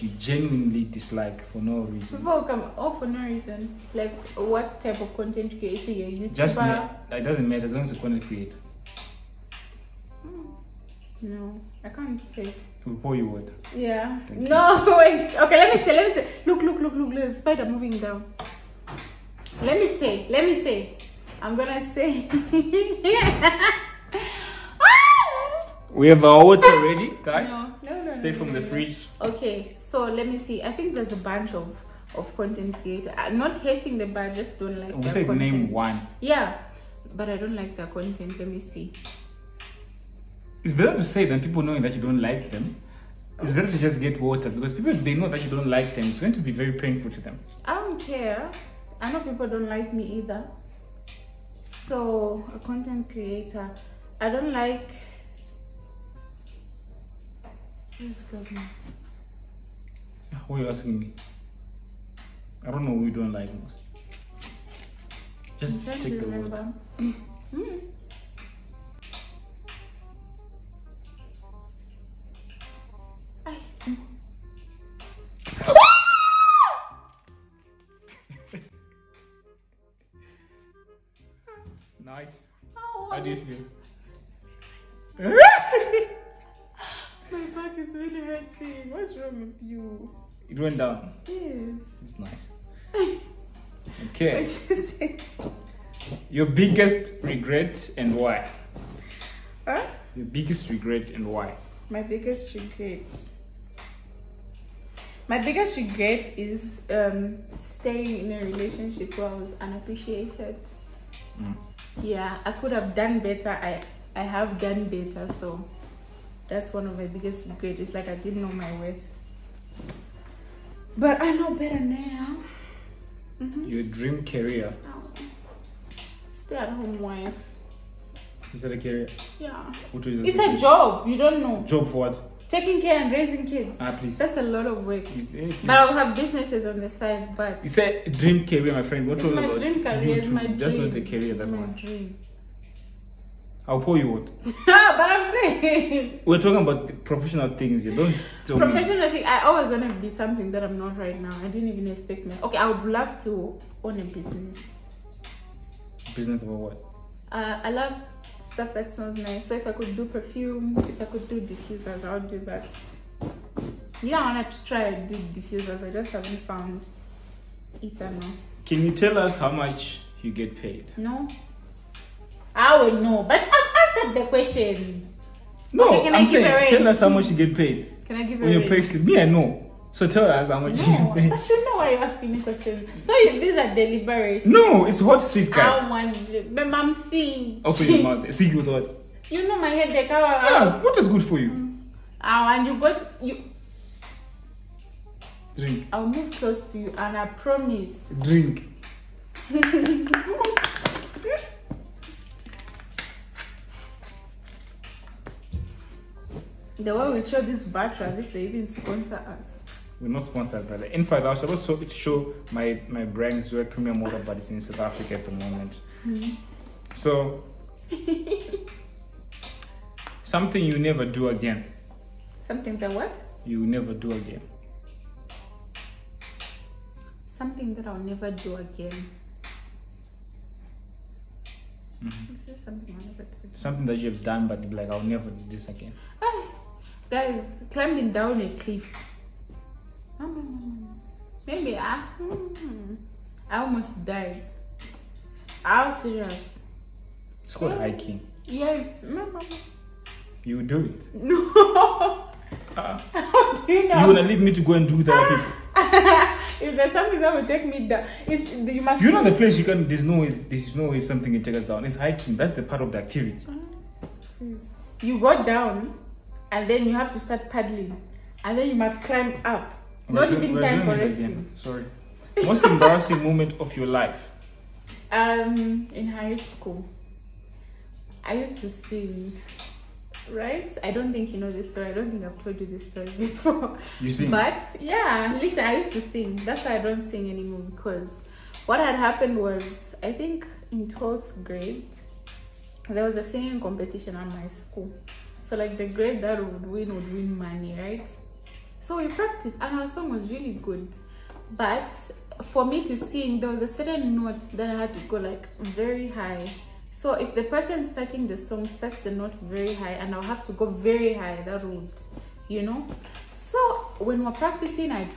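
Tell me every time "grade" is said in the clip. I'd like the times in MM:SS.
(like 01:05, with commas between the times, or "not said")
04:51, 04:55.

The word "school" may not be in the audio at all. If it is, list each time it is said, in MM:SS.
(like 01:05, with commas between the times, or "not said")
04:36, 04:54.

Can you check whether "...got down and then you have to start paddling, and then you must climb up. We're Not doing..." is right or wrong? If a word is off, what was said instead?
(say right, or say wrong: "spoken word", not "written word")
right.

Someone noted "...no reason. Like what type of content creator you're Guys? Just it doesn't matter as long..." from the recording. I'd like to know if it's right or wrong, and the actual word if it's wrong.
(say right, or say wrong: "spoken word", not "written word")
wrong: "YouTuber", not "Guys".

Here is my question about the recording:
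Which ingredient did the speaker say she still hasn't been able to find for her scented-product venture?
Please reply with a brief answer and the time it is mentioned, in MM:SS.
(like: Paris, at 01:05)
Ethanol, at 02:47.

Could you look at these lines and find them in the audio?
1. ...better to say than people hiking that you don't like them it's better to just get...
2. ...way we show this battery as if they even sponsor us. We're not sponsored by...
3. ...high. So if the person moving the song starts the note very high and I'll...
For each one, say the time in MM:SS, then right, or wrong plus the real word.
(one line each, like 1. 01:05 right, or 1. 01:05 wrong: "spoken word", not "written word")
1. 00:40 wrong: "knowing", not "hiking"
2. 03:26 right
3. 05:06 wrong: "starting", not "moving".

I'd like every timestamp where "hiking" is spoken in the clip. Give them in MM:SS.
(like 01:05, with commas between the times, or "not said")
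04:07, 04:21.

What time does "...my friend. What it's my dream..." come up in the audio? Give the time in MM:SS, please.
02:18.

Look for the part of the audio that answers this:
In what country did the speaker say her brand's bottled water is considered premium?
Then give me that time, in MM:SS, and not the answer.
03:34.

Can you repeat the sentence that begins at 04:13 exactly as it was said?
You wanna leave me to go and do that?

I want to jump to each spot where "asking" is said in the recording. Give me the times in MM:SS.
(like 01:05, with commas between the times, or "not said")
01:00, 03:02.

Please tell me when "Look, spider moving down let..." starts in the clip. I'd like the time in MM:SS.
00:17.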